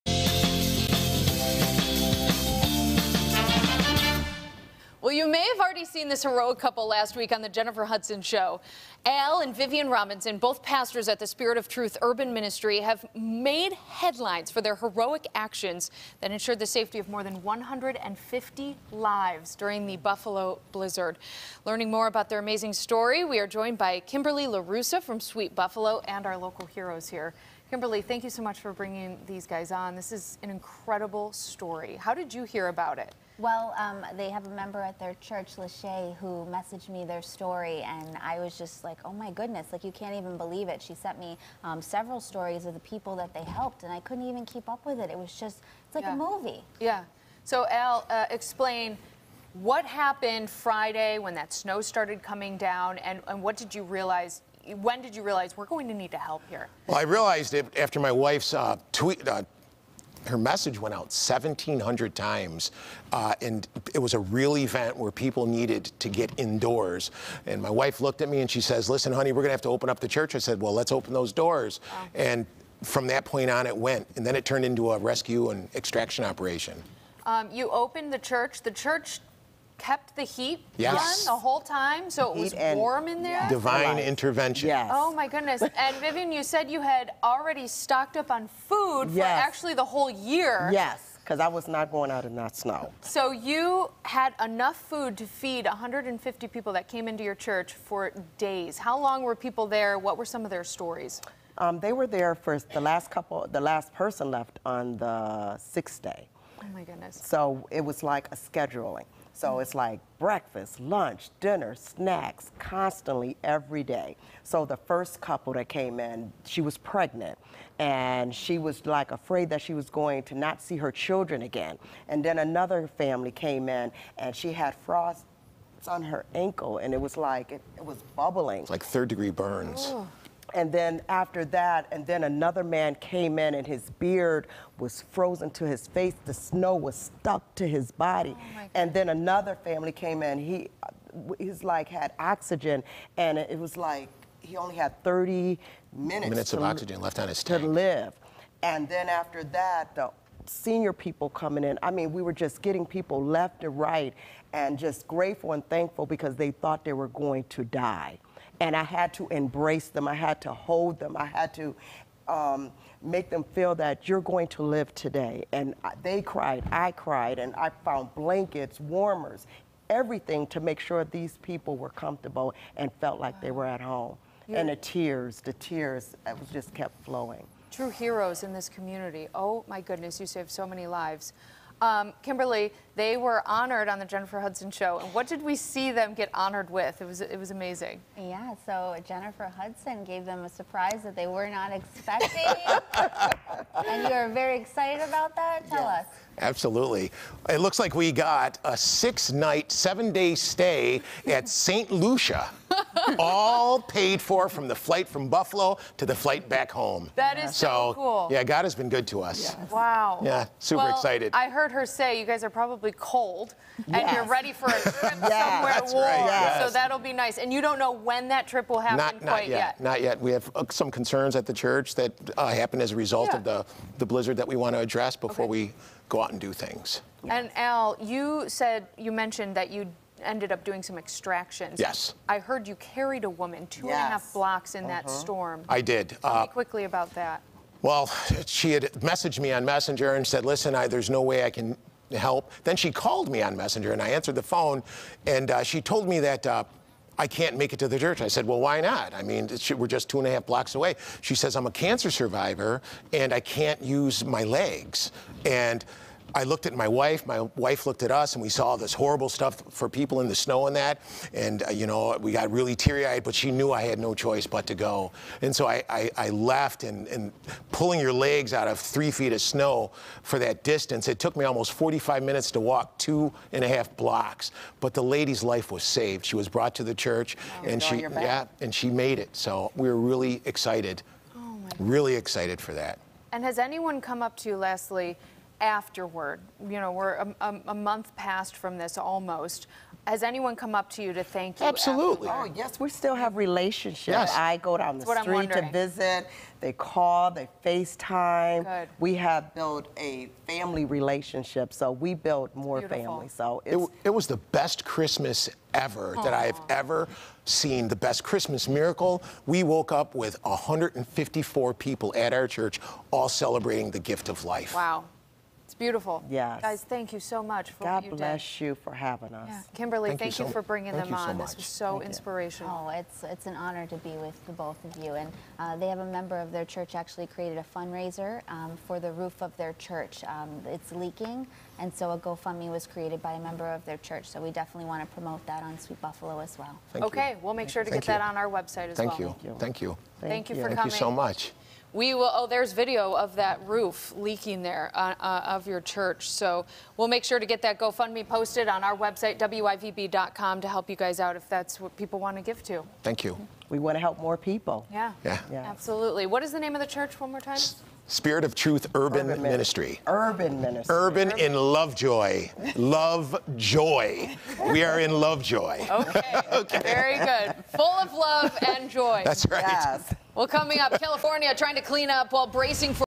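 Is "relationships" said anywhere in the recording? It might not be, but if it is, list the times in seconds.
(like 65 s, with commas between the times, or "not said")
293 s, 300 s.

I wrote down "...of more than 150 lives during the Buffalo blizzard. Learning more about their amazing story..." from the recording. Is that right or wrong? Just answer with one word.
right.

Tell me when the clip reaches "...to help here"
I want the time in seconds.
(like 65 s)
56 s.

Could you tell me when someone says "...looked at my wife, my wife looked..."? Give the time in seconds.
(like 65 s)
256 s.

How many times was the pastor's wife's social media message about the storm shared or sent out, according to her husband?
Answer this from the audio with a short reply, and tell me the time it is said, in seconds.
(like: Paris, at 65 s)
1,700, at 61 s.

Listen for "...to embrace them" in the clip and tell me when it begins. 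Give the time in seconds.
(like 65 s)
159 s.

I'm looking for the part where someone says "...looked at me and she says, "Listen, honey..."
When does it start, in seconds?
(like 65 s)
68 s.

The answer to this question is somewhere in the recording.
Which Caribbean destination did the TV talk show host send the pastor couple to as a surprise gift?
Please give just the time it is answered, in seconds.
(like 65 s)
201 s.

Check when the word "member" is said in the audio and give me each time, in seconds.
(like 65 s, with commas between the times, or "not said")
34 s, 326 s, 333 s.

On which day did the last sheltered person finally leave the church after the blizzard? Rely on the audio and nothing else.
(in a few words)
sixth day.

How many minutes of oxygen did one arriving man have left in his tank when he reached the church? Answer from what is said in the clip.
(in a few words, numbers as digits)
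30 minutes.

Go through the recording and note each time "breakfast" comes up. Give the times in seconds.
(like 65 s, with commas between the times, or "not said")
110 s.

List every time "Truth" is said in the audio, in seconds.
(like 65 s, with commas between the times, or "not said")
11 s, 358 s.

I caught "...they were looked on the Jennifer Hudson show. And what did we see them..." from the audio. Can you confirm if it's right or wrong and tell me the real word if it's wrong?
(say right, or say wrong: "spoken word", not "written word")
wrong: "honored", not "looked".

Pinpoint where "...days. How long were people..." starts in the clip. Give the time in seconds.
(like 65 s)
98 s.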